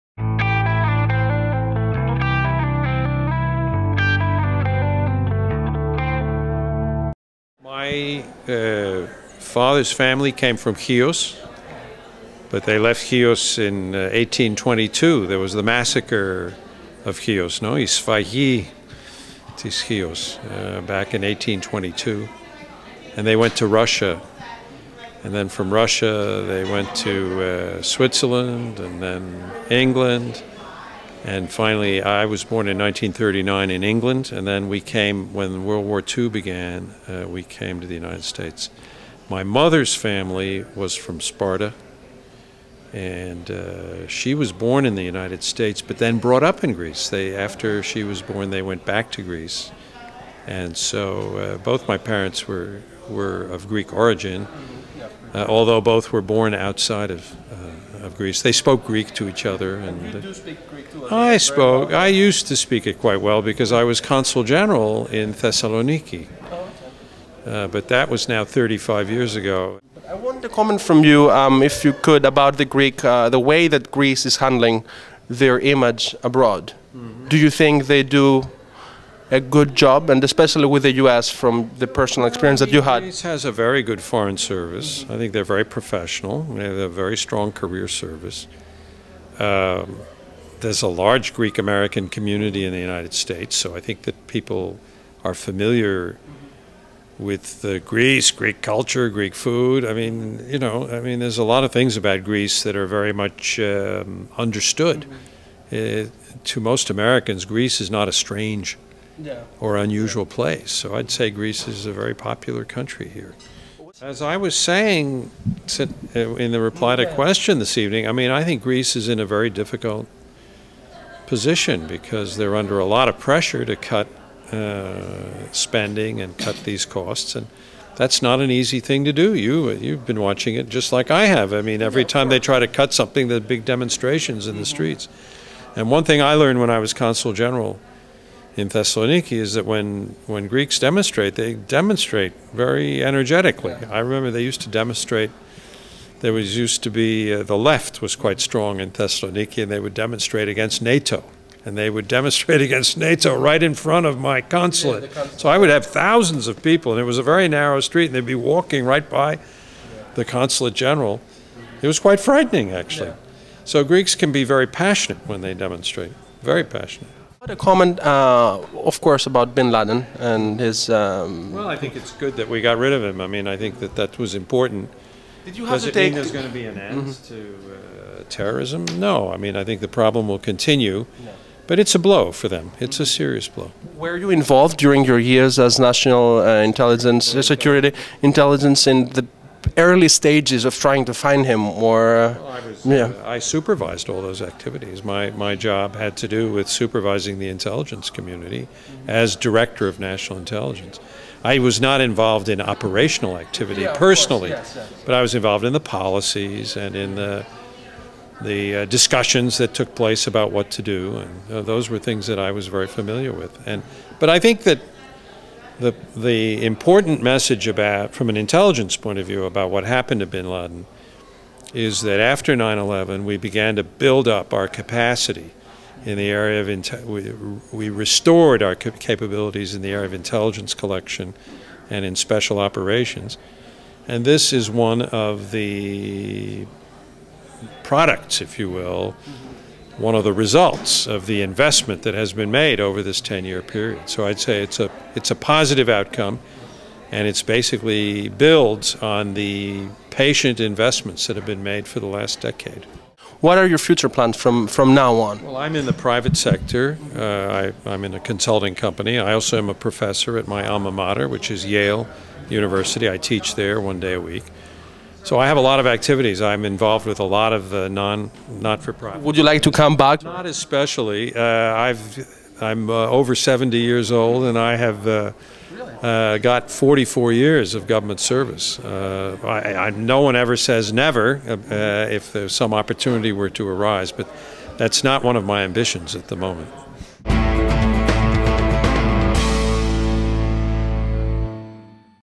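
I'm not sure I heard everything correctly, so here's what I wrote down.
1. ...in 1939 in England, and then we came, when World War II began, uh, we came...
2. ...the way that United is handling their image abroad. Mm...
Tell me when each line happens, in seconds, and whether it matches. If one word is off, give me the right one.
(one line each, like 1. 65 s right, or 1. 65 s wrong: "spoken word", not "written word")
1. 32 s right
2. 73 s wrong: "Greece", not "United".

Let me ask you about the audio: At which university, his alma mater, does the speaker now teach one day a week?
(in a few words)
Yale University.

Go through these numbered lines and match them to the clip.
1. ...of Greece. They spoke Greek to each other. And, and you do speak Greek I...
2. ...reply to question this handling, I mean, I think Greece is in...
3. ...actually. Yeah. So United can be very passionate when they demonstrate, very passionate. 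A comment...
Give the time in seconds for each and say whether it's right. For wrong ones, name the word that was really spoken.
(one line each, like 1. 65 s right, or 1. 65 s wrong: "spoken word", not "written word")
1. 58 s right
2. 116 s wrong: "evening", not "handling"
3. 162 s wrong: "Greeks", not "United".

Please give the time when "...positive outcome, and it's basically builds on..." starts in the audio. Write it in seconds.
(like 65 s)
245 s.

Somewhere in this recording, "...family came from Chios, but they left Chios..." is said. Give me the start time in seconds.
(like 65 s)
9 s.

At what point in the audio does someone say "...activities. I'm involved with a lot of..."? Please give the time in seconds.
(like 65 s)
265 s.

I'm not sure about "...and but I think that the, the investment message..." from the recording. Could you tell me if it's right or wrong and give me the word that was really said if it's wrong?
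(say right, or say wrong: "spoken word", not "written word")
wrong: "important", not "investment".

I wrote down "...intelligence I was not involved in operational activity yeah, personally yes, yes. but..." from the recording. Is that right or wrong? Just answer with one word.
right.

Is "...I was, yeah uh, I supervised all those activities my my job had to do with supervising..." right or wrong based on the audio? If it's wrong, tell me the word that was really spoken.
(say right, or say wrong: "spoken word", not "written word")
right.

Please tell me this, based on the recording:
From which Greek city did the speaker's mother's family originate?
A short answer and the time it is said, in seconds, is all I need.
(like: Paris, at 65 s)
Sparta, at 41 s.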